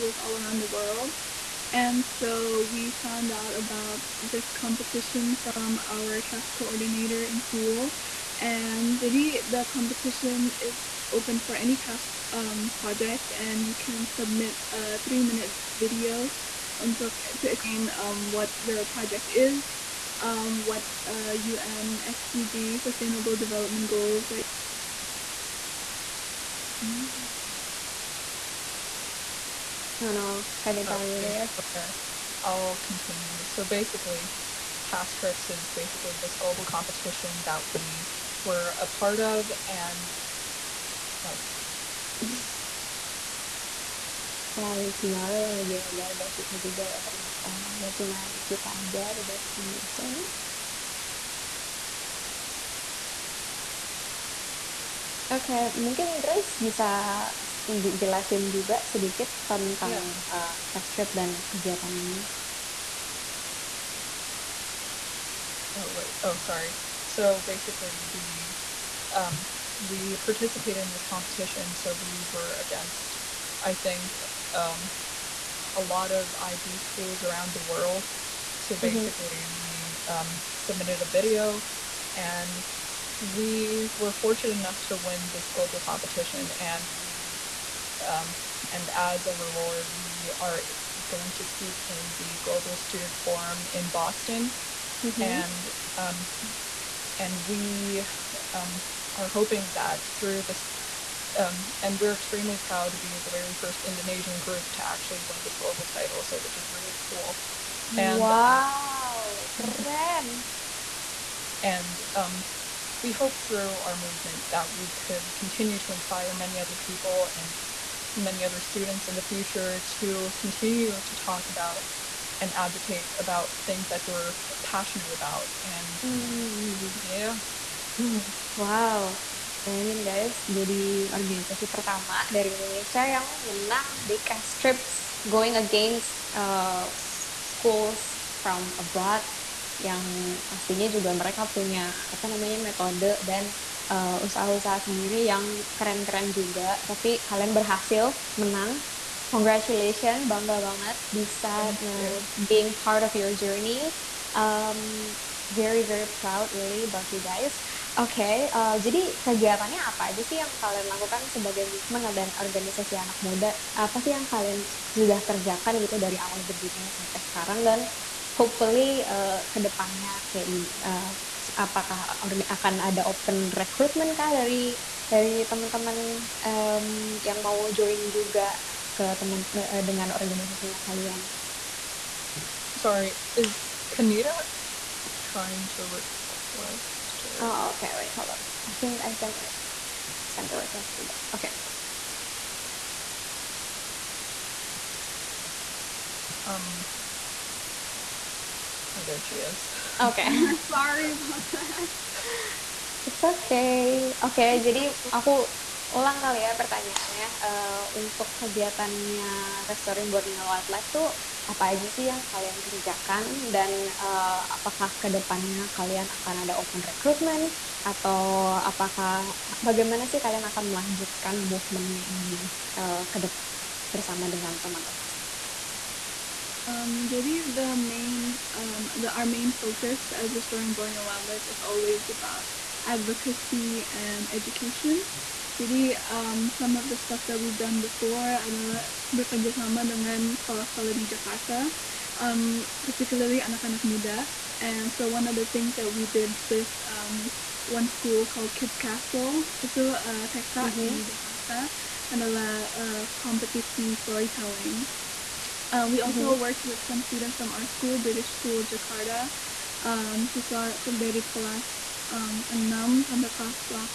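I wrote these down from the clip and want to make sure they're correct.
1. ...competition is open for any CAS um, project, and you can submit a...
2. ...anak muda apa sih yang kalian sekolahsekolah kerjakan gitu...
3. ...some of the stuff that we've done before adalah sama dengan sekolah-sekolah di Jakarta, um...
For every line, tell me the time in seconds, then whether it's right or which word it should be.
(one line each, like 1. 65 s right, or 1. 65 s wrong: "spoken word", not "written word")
1. 9 s right
2. 162 s wrong: "sudah", not "sekolahsekolah"
3. 236 s right.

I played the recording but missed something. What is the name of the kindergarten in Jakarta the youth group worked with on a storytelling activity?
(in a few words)
Kids Castle.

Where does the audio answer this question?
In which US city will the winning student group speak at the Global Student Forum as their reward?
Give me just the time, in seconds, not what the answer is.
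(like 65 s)
93 s.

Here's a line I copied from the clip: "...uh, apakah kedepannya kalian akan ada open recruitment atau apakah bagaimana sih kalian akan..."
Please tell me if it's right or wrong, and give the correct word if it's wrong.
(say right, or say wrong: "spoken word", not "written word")
right.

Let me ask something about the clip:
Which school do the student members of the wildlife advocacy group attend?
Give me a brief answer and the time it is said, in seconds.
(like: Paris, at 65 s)
British School Jakarta, at 257 s.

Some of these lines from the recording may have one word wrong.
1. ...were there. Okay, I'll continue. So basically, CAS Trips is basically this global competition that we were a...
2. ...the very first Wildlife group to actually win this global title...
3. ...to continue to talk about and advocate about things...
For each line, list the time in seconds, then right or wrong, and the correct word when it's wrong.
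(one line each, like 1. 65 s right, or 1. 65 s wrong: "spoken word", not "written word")
1. 31 s right
2. 103 s wrong: "Indonesian", not "Wildlife"
3. 119 s right.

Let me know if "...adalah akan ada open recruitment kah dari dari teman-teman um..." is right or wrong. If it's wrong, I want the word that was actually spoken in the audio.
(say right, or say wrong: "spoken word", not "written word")
wrong: "apakah", not "adalah".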